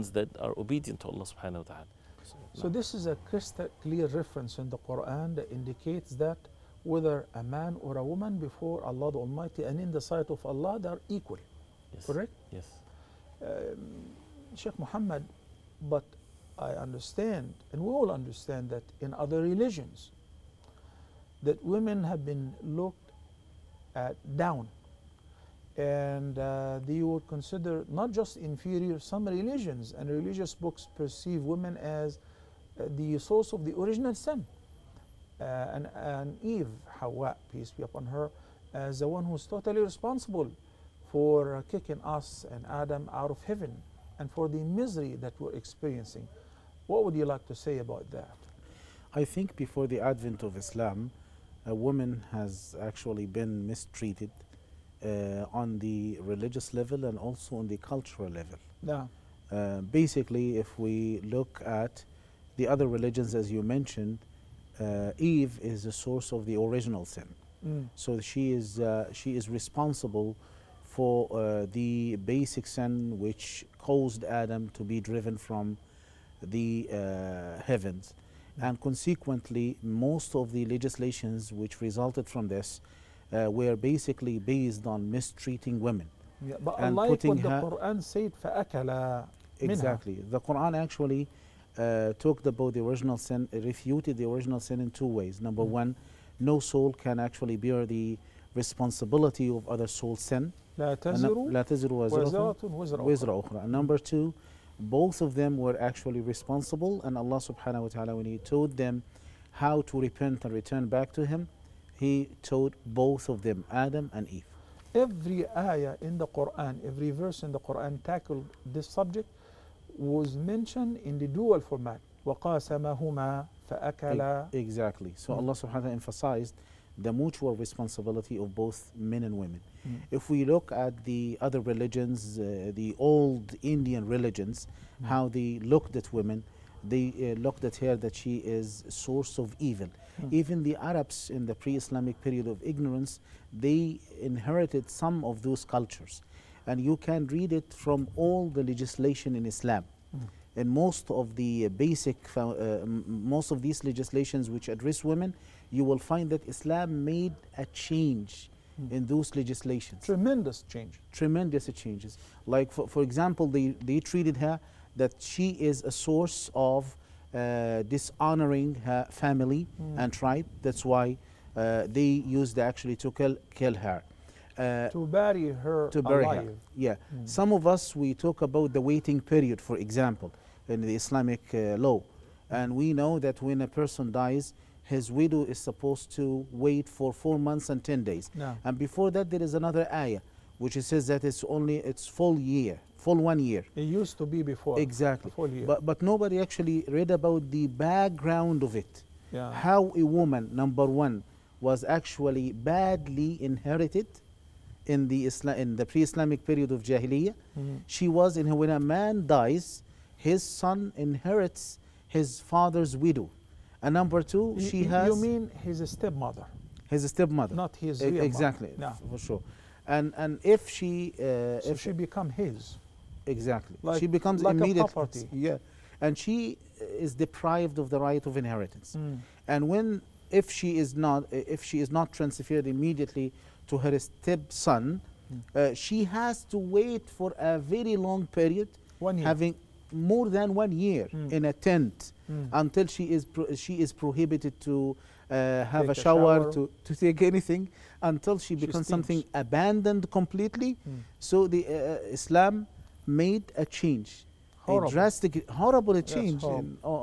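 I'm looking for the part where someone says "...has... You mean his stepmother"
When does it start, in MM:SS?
03:34.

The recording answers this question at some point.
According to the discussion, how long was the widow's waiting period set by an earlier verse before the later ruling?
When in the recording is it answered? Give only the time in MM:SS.
03:12.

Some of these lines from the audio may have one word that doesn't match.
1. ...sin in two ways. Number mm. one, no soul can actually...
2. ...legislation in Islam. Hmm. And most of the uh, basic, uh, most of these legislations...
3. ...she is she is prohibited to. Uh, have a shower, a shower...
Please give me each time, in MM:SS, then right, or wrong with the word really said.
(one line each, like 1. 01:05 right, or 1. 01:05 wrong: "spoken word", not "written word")
1. 01:34 right
2. 02:28 right
3. 04:02 right.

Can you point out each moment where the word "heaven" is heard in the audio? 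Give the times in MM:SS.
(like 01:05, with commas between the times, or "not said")
00:43, 01:17.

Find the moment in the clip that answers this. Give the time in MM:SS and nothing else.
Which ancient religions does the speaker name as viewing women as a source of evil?
02:12.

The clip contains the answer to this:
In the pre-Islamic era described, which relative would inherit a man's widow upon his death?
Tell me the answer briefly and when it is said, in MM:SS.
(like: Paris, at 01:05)
his son, at 03:30.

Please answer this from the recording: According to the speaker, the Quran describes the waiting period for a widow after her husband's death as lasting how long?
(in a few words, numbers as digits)
4 months and 10 days.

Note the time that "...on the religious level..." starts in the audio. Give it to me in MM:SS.
00:55.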